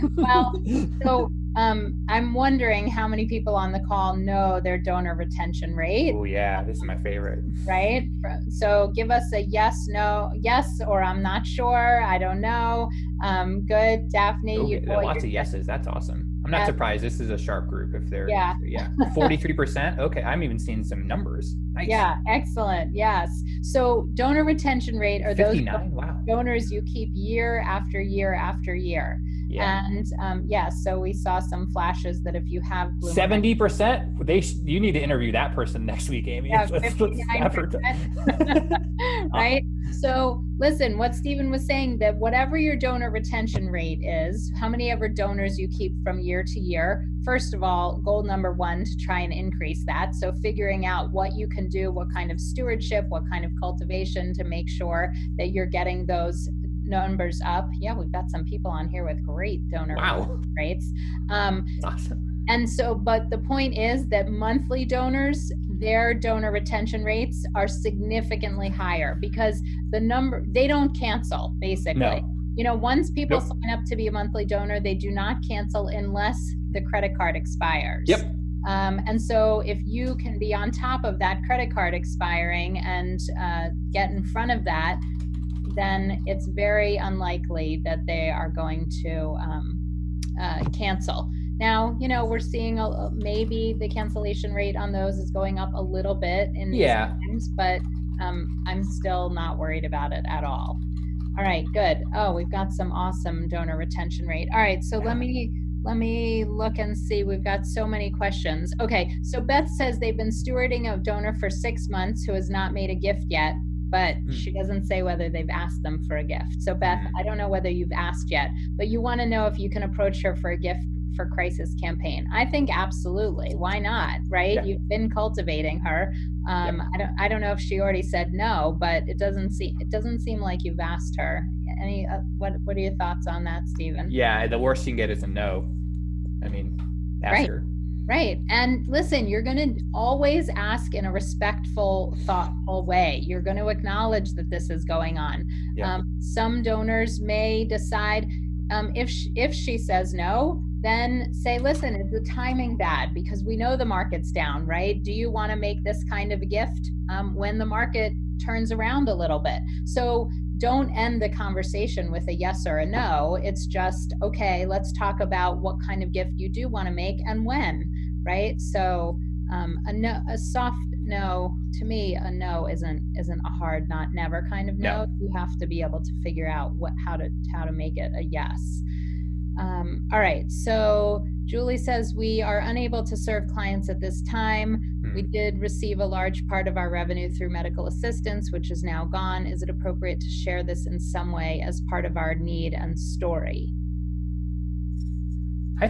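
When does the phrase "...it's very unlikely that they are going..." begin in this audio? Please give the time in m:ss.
1:26.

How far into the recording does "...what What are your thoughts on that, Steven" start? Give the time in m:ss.
2:12.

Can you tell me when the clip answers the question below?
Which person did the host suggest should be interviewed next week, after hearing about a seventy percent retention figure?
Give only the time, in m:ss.
0:36.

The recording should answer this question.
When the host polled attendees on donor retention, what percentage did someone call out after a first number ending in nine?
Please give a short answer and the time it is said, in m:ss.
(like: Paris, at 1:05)
59%, at 0:25.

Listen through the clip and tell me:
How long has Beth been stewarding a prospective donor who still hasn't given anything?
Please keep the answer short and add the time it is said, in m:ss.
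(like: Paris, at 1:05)
6 months, at 1:51.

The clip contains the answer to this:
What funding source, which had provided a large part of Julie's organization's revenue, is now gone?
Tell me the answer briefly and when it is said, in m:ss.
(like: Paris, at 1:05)
medical assistance, at 3:07.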